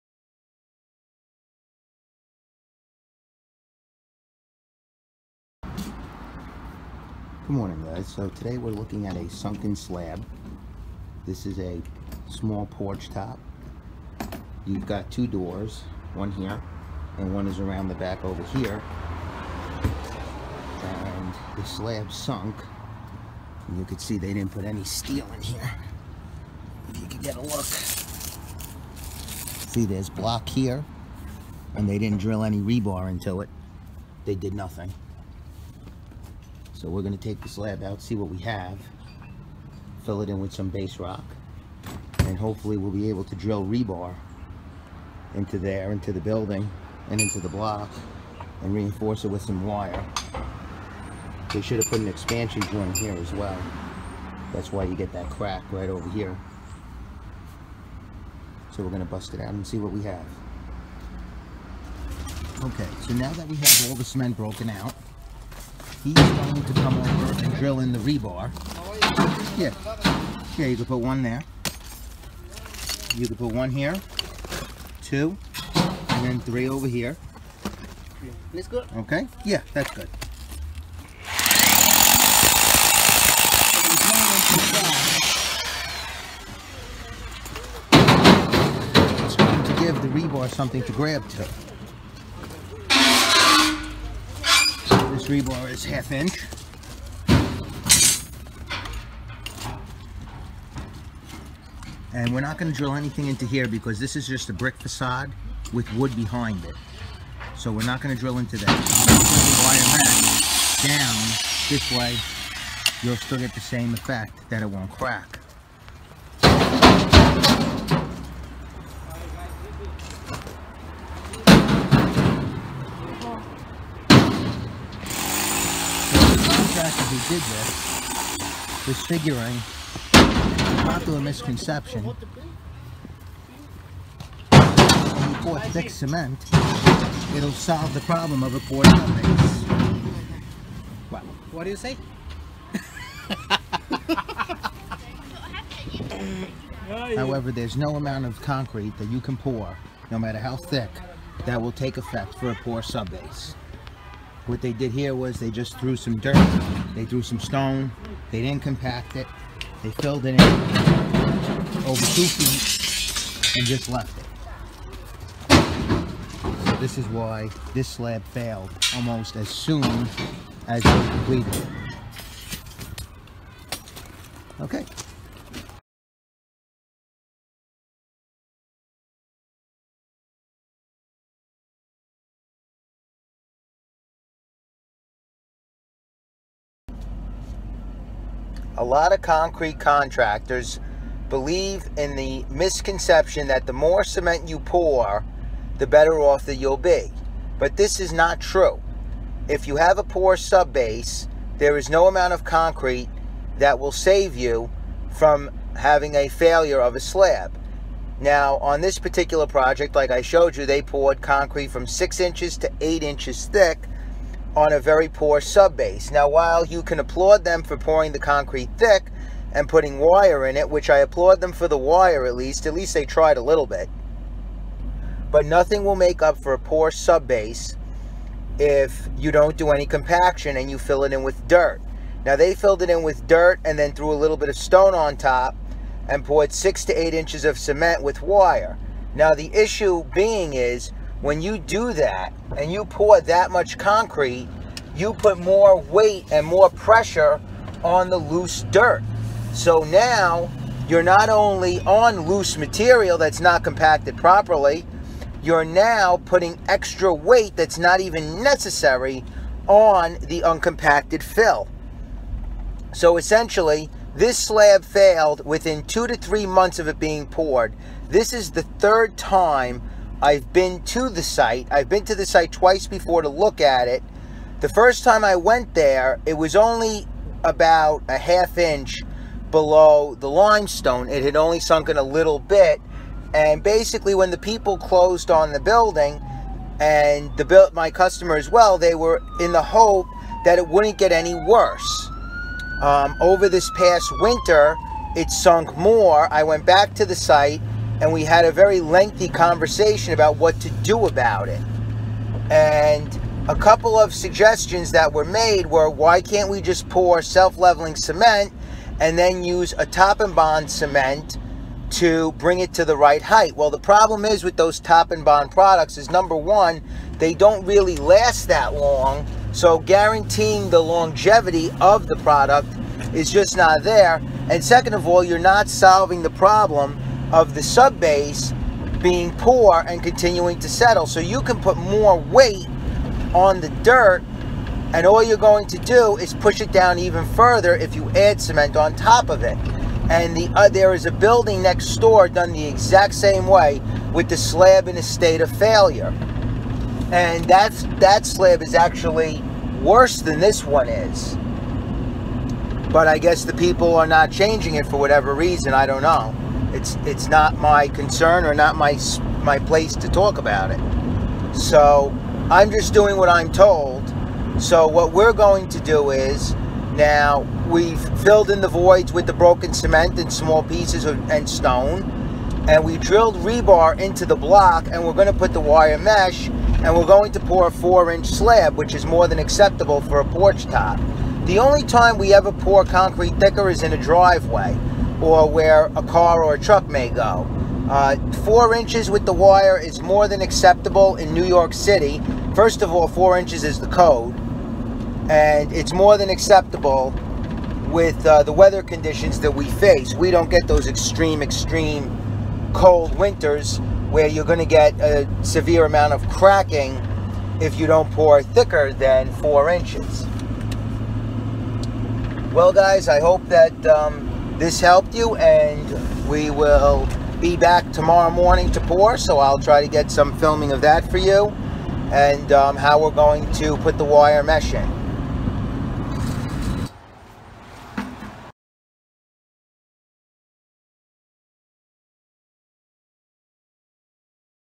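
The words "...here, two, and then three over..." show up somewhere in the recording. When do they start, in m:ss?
1:13.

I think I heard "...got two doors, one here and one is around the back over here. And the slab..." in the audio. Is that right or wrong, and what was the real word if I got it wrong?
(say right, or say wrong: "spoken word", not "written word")
right.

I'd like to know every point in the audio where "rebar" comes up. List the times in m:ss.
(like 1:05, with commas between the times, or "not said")
0:32, 0:43, 1:07, 1:30, 1:35, 6:13.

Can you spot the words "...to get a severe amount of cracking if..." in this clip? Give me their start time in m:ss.
6:44.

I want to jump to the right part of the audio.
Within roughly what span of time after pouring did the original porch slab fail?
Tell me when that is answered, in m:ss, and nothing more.
4:25.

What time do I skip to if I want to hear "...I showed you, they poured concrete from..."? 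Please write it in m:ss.
3:30.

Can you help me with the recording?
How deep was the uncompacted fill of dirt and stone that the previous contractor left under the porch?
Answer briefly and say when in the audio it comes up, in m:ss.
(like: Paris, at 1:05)
over two feet, at 2:41.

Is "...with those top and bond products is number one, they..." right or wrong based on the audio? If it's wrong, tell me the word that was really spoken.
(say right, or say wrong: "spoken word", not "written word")
right.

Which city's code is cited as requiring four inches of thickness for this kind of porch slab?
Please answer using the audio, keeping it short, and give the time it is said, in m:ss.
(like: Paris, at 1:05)
New York City, at 6:31.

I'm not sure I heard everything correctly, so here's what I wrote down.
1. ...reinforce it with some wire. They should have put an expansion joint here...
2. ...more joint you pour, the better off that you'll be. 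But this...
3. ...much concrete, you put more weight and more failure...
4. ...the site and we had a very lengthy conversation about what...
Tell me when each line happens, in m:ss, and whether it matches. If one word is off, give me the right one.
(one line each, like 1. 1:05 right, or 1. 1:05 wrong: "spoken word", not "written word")
1. 0:48 right
2. 3:13 wrong: "cement", not "joint"
3. 4:03 wrong: "pressure", not "failure"
4. 4:57 right.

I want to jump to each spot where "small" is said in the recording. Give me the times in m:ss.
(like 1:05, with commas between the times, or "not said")
0:12, 6:10.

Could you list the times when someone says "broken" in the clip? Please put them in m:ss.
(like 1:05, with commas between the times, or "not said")
1:04, 6:09.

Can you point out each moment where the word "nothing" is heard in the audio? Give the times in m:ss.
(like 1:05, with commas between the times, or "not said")
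0:34, 3:45.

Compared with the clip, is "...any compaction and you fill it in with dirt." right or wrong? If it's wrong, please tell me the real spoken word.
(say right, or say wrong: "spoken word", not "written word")
right.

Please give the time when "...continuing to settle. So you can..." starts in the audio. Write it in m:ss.
5:30.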